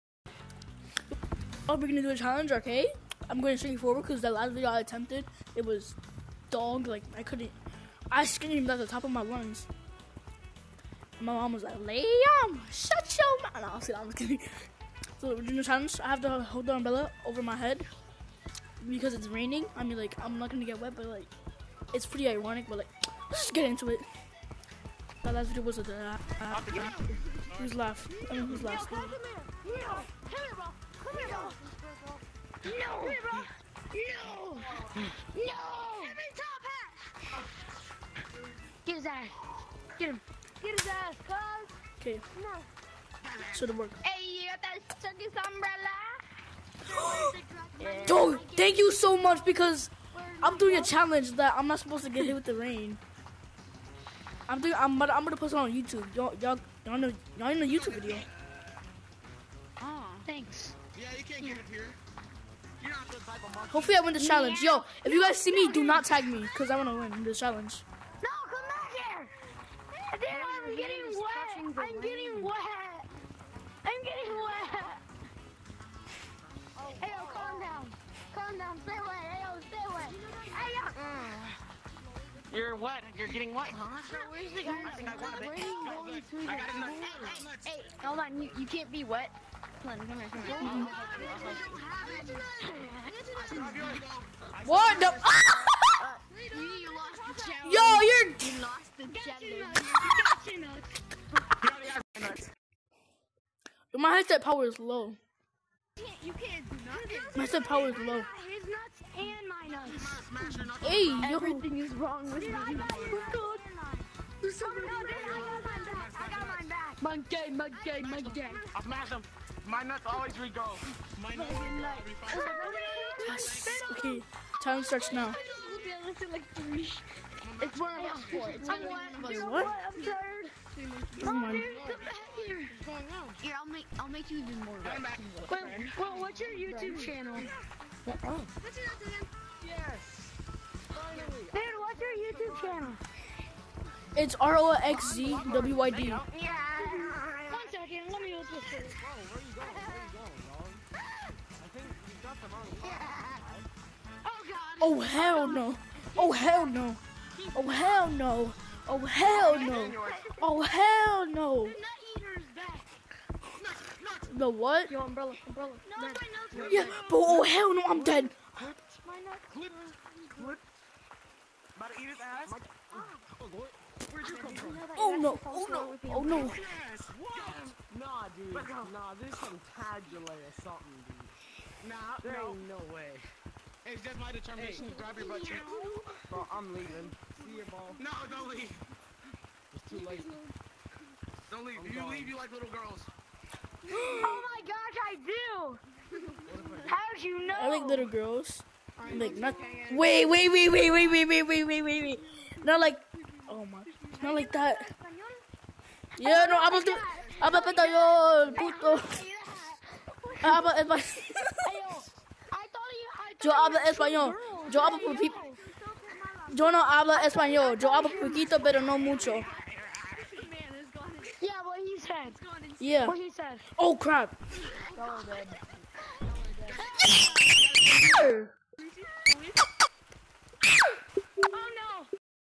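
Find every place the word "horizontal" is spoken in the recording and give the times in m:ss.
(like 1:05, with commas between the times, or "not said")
not said.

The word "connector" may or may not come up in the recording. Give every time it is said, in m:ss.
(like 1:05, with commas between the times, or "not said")
not said.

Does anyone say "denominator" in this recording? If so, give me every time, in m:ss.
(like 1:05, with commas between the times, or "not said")
not said.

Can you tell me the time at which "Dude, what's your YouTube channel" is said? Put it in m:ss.
2:21.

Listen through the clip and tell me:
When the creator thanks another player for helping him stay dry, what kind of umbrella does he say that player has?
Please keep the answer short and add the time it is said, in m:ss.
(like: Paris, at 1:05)
Circus umbrella, at 0:45.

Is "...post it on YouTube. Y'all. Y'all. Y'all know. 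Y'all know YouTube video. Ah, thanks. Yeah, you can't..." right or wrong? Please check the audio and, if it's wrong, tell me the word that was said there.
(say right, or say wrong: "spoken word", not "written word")
right.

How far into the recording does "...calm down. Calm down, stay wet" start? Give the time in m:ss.
1:17.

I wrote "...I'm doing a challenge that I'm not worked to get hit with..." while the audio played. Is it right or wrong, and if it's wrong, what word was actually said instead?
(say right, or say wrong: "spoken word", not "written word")
wrong: "supposed", not "worked".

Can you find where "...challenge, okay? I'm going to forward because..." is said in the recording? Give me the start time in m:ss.
0:02.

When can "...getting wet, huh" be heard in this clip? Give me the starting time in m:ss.
1:23.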